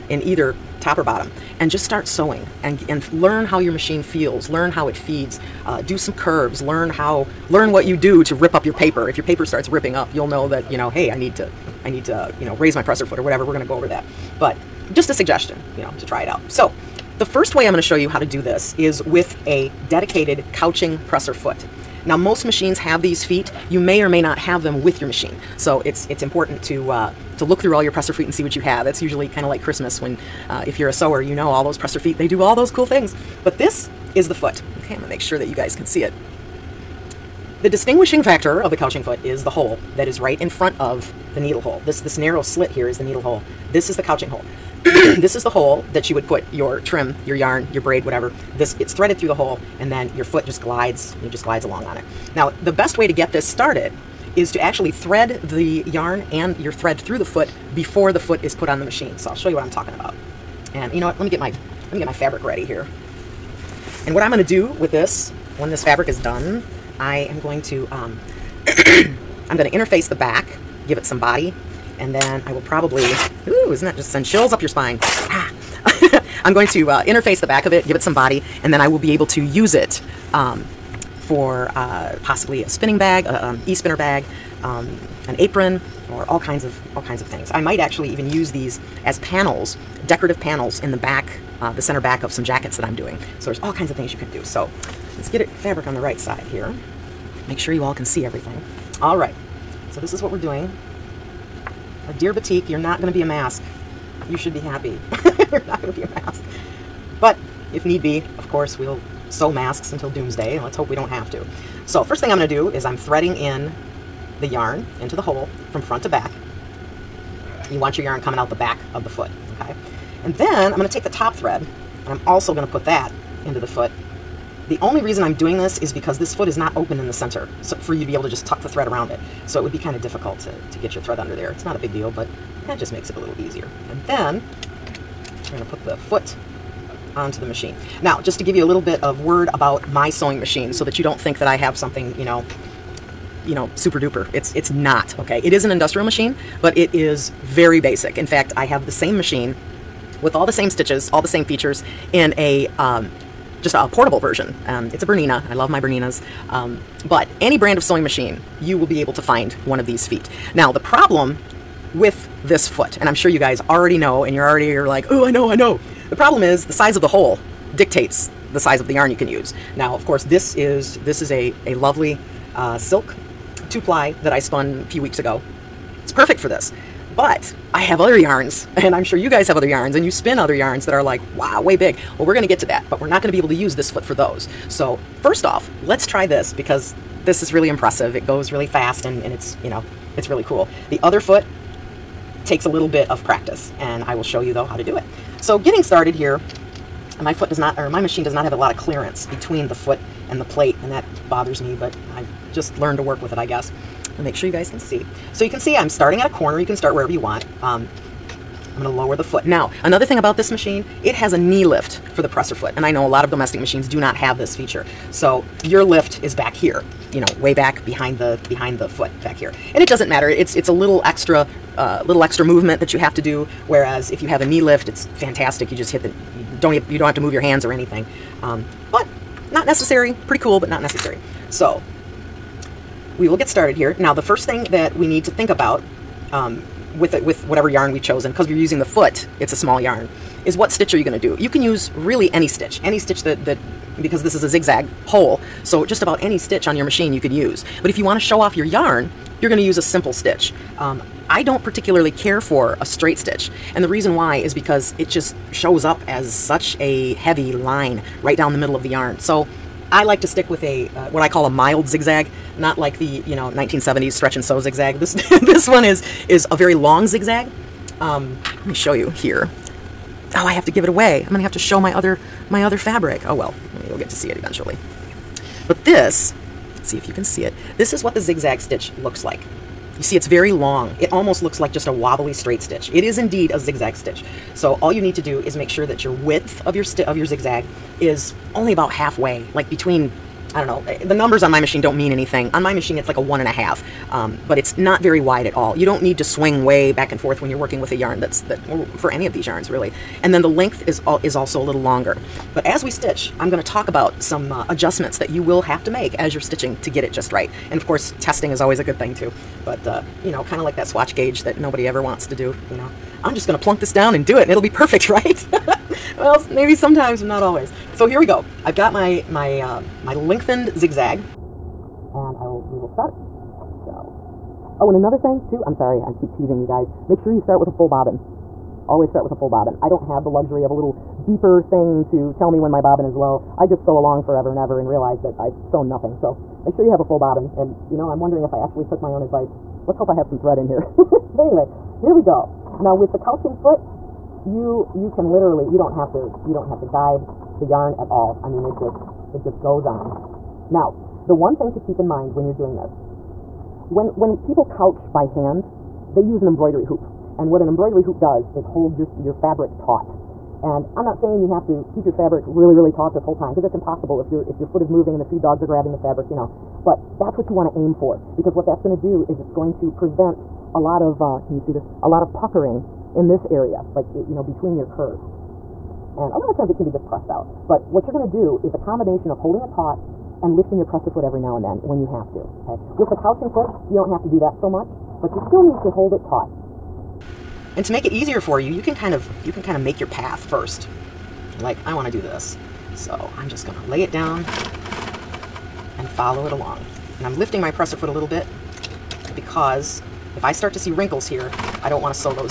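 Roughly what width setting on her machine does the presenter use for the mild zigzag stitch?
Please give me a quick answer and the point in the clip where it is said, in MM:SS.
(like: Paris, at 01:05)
1.5, at 04:53.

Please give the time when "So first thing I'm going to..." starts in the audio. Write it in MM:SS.
01:51.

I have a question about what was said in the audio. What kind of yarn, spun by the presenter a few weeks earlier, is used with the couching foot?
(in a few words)
silk two ply.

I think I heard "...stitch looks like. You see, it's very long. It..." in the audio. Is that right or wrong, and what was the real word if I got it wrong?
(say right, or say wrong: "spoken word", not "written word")
right.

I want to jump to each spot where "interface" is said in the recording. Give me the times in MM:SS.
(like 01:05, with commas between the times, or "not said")
01:09, 01:17.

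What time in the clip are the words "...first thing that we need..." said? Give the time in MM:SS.
03:54.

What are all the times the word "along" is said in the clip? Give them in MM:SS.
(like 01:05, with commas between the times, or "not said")
00:51, 05:33, 06:36.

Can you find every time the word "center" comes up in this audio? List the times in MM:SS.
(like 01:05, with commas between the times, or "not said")
01:31, 02:07.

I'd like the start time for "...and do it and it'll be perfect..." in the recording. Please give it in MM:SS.
05:14.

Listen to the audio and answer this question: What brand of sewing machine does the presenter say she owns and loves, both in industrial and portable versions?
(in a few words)
Bernina.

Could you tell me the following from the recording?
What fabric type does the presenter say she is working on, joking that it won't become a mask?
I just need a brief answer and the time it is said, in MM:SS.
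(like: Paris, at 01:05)
batik, at 01:42.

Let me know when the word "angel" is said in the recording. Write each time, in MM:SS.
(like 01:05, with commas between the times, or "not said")
not said.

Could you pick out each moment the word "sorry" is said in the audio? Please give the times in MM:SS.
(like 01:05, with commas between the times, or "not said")
05:25.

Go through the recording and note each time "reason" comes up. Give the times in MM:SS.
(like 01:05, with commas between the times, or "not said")
02:05, 04:13.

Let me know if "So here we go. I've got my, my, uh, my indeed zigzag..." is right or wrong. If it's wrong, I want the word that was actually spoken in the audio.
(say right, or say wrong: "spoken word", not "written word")
wrong: "lengthened", not "indeed".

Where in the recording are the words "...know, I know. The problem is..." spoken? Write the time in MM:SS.
02:45.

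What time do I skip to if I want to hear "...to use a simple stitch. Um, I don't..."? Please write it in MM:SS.
04:09.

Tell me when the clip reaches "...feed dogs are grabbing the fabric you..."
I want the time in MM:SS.
06:05.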